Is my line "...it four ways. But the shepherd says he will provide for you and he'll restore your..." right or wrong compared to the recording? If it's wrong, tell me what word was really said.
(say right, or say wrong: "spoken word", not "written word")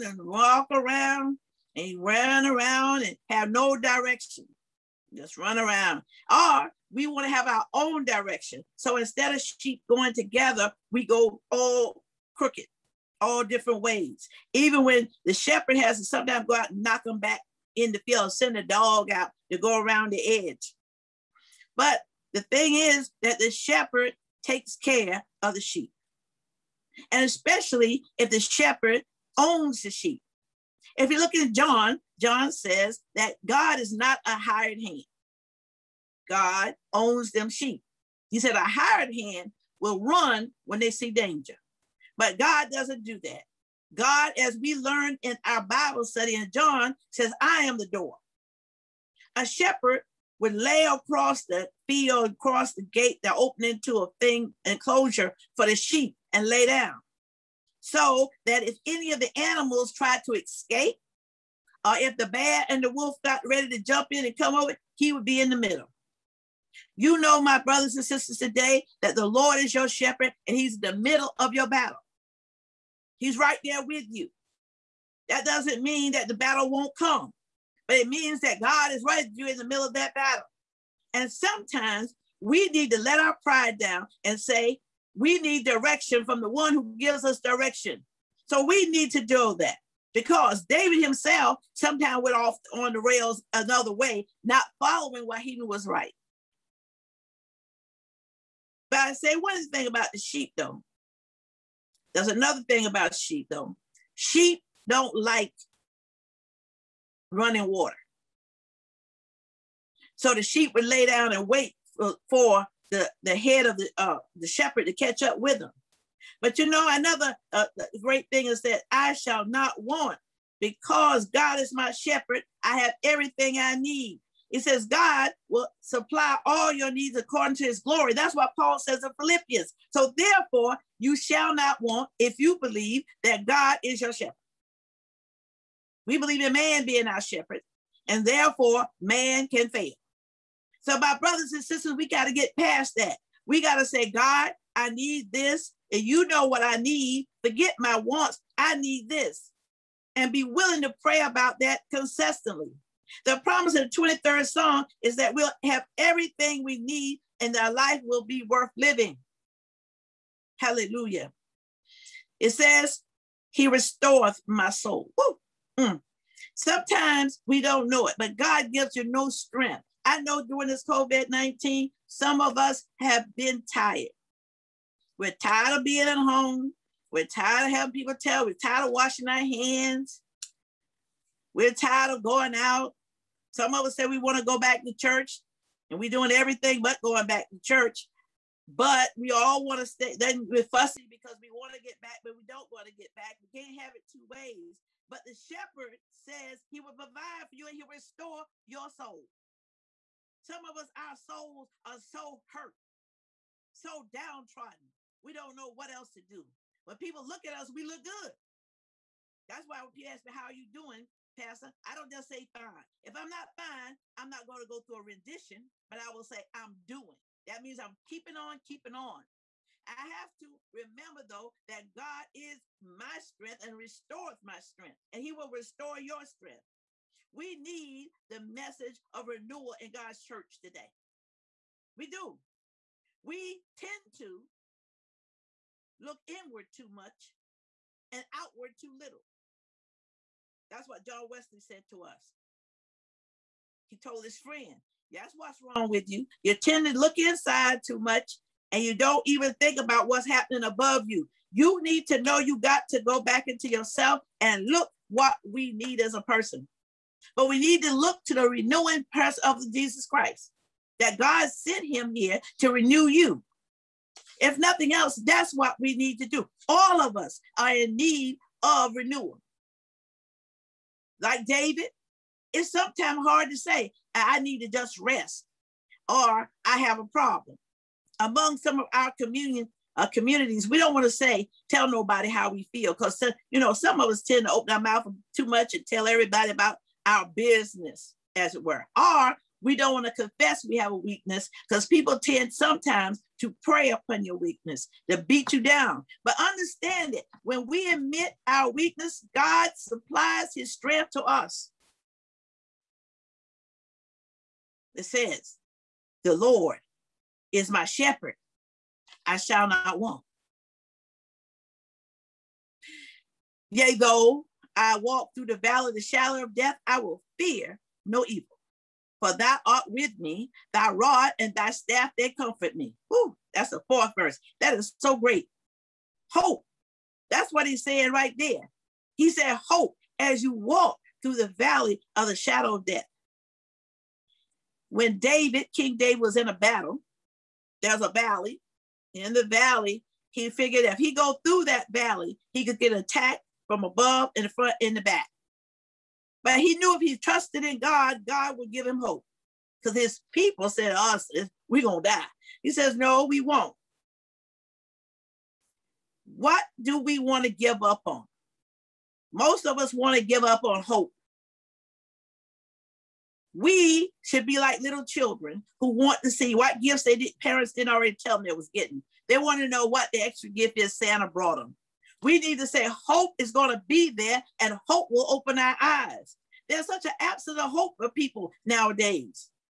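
wrong: "two", not "four".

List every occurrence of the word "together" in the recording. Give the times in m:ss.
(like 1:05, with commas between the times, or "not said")
0:10.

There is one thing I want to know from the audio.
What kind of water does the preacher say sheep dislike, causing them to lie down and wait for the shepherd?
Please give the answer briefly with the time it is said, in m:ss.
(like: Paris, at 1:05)
Running water, at 1:47.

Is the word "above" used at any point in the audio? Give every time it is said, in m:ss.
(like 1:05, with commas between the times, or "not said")
4:10, 5:43.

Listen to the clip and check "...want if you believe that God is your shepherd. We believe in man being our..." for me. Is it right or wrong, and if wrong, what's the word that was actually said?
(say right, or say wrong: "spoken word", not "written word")
right.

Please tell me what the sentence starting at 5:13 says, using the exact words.
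Yea, though I walk through the valley of the shadow of death, I will fear no evil.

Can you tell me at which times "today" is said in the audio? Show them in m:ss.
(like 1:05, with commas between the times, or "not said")
1:08, 3:50.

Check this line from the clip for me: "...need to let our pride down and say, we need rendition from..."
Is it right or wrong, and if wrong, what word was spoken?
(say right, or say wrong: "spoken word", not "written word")
wrong: "direction", not "rendition".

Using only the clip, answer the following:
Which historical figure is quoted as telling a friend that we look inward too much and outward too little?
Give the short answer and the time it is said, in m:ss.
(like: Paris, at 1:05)
John Wesley, at 4:01.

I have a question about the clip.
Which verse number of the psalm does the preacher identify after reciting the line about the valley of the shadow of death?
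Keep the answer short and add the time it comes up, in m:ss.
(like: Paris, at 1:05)
4th, at 5:23.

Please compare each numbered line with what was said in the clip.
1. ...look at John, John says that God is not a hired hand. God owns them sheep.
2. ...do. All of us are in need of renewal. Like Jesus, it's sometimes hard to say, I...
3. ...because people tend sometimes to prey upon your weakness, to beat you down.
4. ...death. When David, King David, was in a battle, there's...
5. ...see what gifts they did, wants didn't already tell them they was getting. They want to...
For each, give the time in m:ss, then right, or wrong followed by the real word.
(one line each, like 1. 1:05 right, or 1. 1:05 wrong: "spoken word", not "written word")
1. 0:31 right
2. 4:26 wrong: "David", not "Jesus"
3. 4:51 right
4. 5:32 right
5. 6:06 wrong: "parents", not "wants".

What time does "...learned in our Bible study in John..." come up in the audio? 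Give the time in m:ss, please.
0:44.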